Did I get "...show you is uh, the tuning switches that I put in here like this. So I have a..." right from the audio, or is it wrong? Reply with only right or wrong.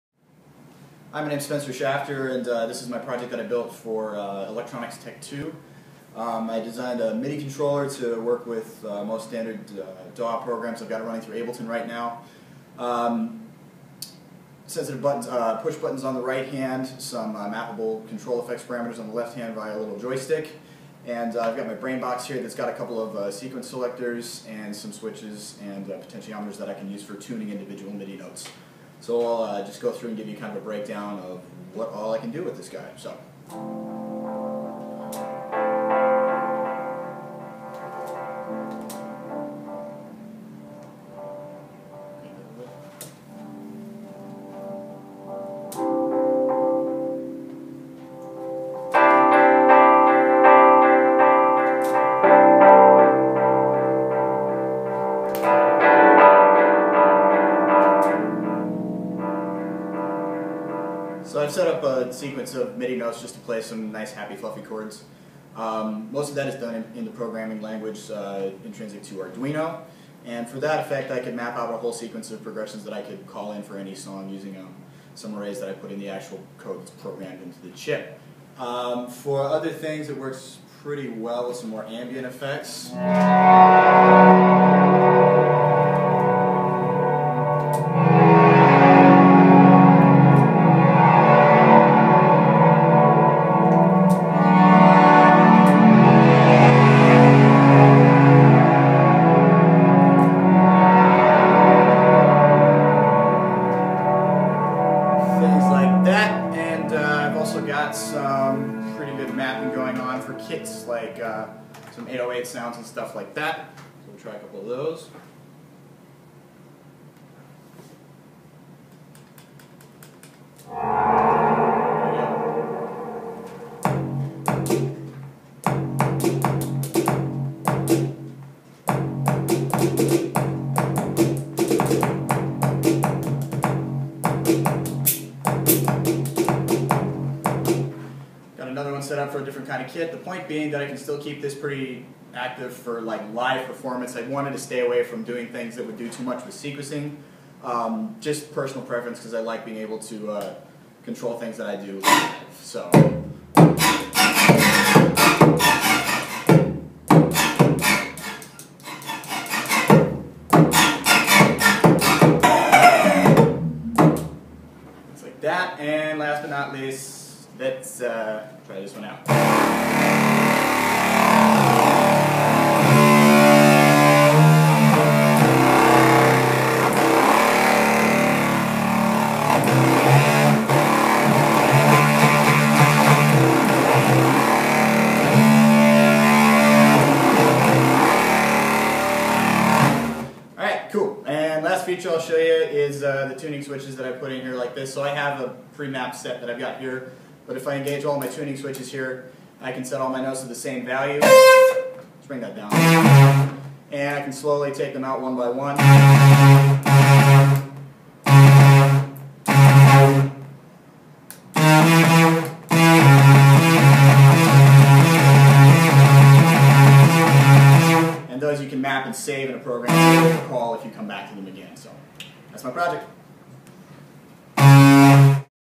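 right.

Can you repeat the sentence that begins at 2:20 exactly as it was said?
The point being that I can still keep this pretty active for like live performance.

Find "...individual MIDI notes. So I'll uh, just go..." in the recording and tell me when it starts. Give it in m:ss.
0:27.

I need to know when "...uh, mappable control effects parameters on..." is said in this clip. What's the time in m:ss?
0:17.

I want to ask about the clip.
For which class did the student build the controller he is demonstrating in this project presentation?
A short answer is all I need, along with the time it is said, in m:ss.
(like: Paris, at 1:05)
Electronics Tech 2, at 0:04.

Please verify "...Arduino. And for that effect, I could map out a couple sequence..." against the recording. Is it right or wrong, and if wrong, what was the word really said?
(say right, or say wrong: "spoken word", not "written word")
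wrong: "whole", not "couple".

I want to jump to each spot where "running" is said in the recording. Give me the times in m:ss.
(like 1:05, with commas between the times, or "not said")
0:11.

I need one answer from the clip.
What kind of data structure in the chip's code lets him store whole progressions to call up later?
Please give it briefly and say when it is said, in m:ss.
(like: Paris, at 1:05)
Arrays, at 1:15.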